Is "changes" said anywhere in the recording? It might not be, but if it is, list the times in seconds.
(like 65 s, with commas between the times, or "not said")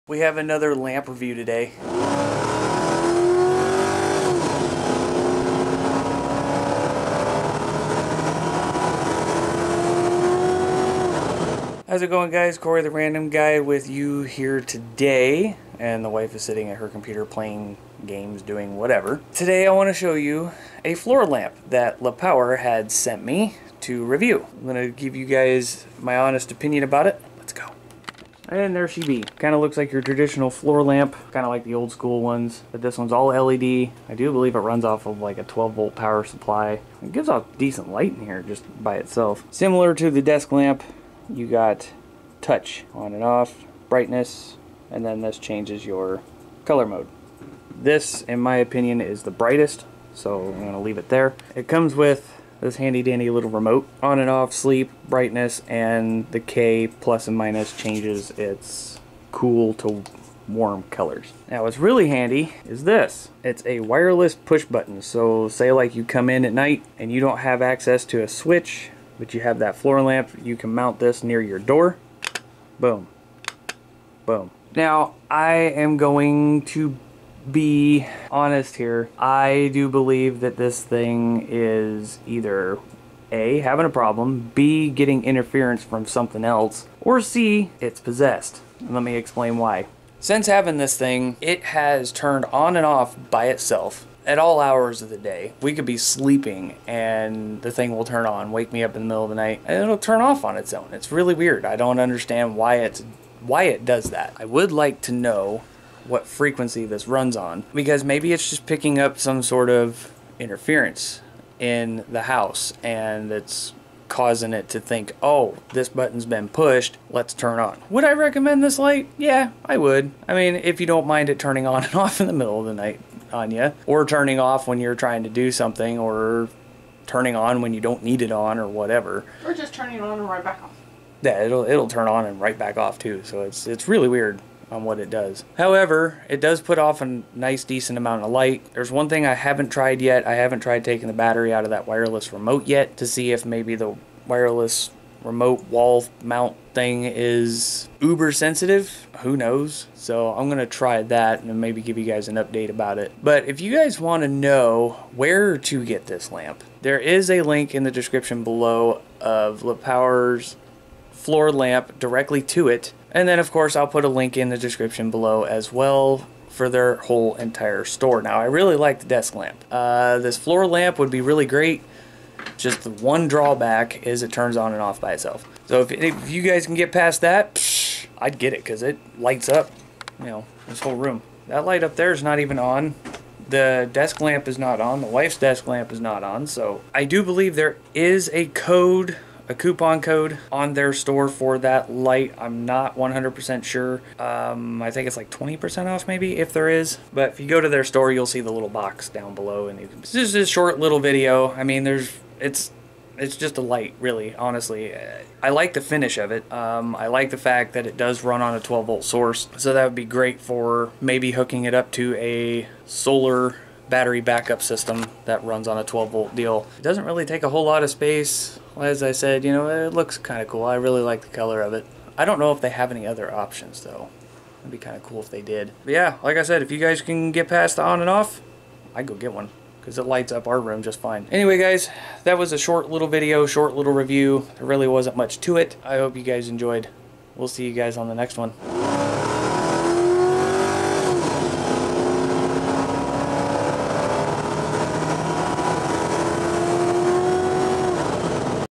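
45 s, 57 s.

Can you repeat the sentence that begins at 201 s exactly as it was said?
I mean, there's it's it's just a light, really, honestly.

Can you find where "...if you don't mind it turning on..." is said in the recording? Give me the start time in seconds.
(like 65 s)
120 s.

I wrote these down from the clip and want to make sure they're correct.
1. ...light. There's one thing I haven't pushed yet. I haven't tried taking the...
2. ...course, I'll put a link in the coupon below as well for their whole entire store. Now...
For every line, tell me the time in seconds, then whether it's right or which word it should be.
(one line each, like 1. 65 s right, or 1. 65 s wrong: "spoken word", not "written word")
1. 138 s wrong: "tried", not "pushed"
2. 163 s wrong: "description", not "coupon".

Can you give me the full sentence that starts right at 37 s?
It gives off decent light in here just by itself.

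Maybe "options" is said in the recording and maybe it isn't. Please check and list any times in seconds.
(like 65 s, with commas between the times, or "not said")
223 s.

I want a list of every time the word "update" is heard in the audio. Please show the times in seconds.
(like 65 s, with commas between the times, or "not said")
152 s.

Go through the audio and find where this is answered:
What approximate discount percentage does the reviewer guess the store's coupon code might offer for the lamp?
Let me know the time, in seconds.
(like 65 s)
195 s.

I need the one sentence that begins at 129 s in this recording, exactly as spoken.
Or just turning on and right back off.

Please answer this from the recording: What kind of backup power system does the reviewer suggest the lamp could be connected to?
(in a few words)
solar battery backup system.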